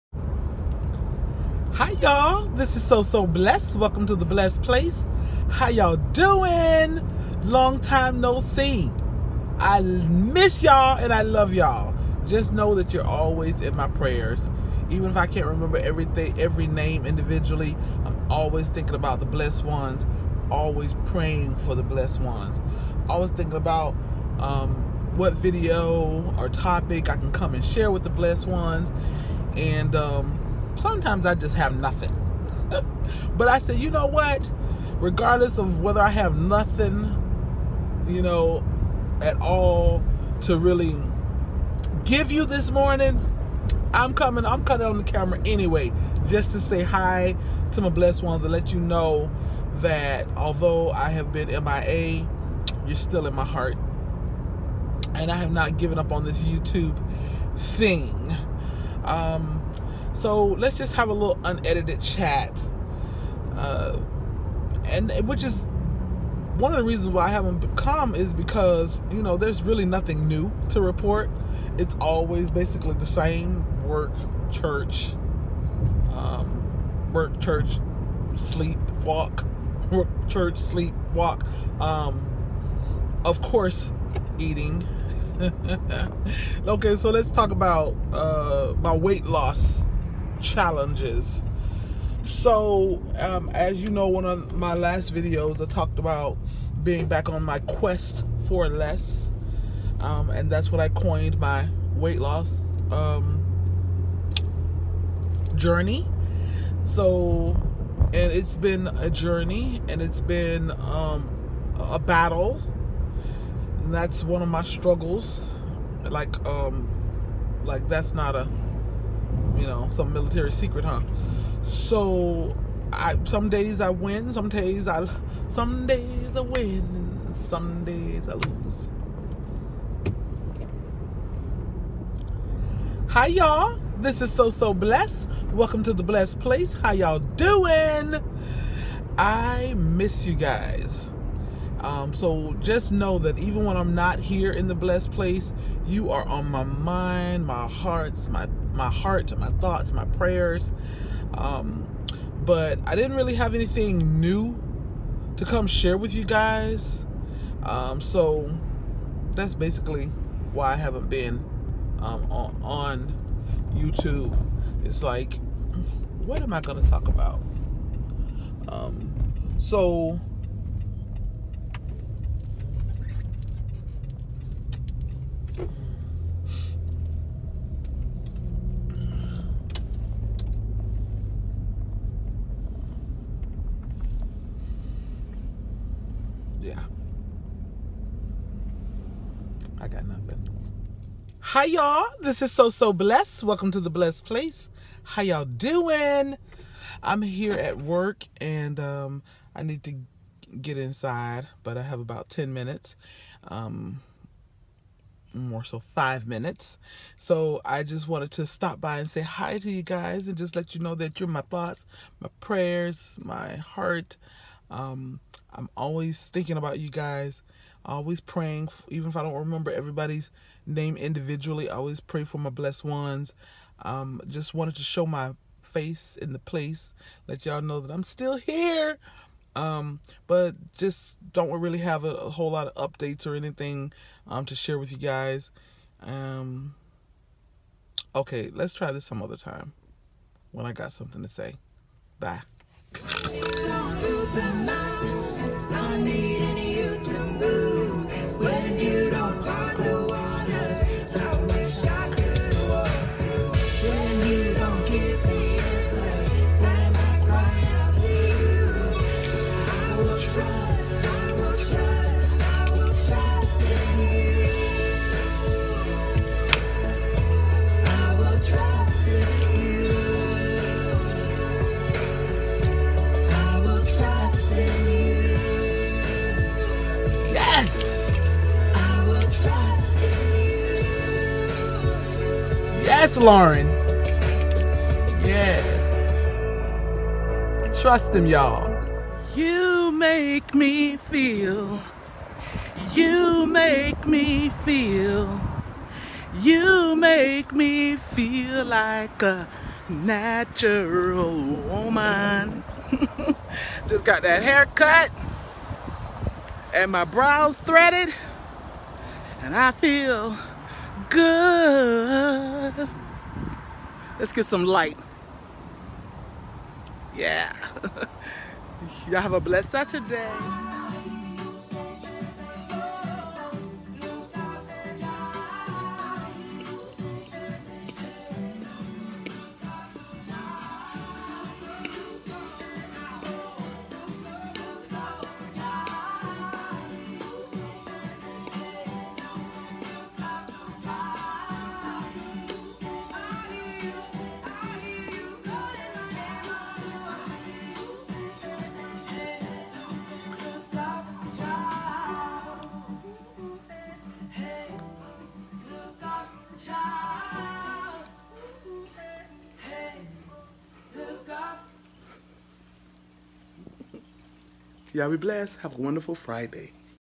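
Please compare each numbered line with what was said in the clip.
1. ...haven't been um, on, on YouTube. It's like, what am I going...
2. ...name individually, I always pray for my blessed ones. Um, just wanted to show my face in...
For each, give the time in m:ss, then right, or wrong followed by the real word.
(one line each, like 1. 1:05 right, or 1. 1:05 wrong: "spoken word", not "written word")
1. 2:40 right
2. 3:40 right.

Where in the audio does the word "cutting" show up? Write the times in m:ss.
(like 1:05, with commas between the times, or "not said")
0:44.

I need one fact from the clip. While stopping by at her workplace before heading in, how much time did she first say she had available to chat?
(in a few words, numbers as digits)
10 minutes.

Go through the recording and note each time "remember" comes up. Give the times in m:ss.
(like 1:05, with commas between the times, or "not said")
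0:15, 3:39.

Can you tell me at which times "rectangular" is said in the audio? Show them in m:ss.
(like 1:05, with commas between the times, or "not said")
not said.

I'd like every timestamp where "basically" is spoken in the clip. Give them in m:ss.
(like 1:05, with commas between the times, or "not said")
1:12, 2:39.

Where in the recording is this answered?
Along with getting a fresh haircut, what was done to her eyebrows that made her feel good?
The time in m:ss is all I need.
5:07.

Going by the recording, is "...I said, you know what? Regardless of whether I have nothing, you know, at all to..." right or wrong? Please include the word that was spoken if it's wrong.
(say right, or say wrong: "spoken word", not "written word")
right.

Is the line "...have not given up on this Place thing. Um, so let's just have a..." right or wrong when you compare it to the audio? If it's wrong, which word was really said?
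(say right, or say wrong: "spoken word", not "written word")
wrong: "YouTube", not "Place".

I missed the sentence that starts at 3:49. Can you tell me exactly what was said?
Um, but just don't really have a, a, whole lot of updates or anything um, to share with you guys.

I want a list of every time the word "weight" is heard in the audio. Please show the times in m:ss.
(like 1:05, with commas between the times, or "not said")
1:28, 1:41.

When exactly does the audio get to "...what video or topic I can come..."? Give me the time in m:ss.
0:25.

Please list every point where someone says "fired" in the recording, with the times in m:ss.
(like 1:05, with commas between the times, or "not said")
not said.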